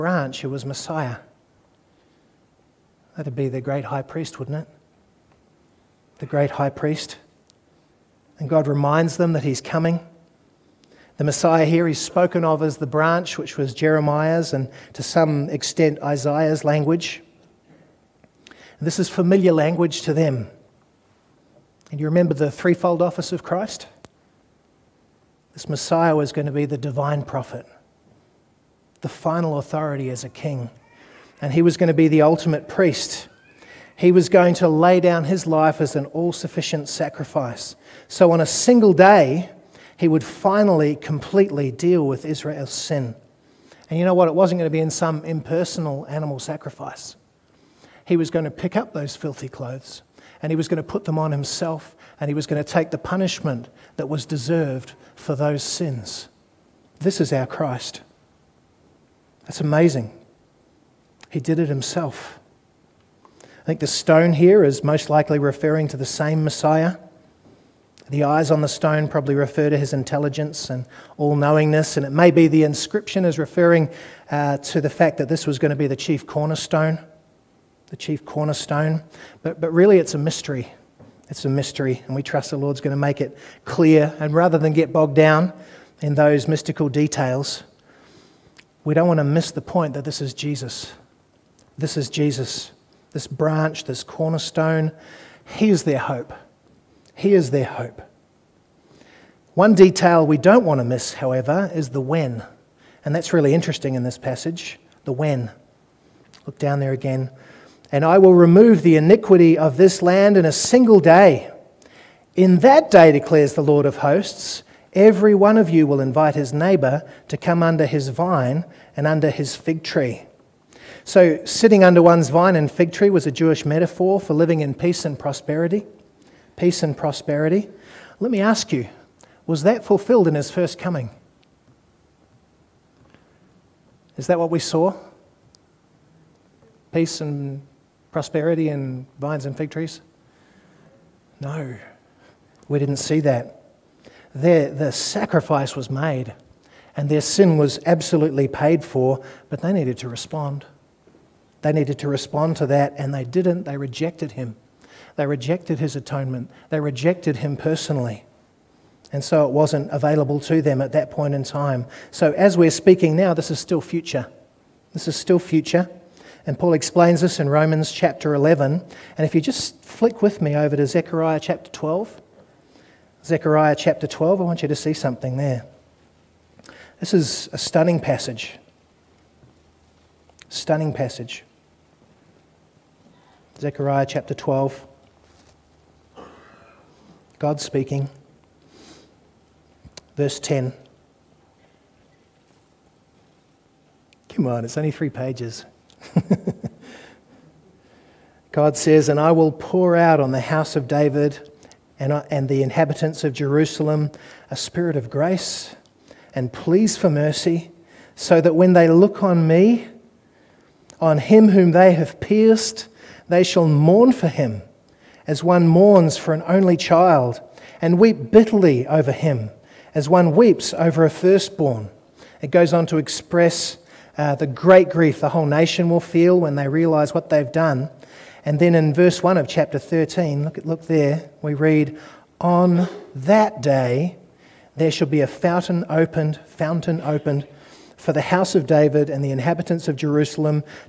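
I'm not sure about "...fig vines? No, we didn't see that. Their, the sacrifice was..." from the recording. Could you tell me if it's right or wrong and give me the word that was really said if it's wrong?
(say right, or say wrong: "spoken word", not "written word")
wrong: "trees", not "vines".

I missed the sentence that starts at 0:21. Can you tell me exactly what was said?
And you remember the threefold office of Christ?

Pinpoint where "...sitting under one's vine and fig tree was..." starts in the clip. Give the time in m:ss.
2:01.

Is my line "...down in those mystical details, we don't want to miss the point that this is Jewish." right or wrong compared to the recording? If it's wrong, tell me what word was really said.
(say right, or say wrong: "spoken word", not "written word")
wrong: "Jesus", not "Jewish".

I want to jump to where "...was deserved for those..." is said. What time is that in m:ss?
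0:54.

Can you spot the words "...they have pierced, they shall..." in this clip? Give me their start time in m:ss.
3:31.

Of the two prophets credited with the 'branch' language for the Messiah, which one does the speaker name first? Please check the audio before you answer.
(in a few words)
Jeremiah.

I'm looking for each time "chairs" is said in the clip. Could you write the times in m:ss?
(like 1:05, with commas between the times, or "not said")
not said.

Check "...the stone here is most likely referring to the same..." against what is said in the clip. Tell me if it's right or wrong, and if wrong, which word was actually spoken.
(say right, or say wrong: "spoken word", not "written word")
right.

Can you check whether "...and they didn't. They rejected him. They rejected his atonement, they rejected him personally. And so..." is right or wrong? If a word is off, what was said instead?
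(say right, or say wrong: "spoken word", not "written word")
right.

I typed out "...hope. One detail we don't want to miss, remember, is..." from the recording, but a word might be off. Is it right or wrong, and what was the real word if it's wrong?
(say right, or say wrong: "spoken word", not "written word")
wrong: "however", not "remember".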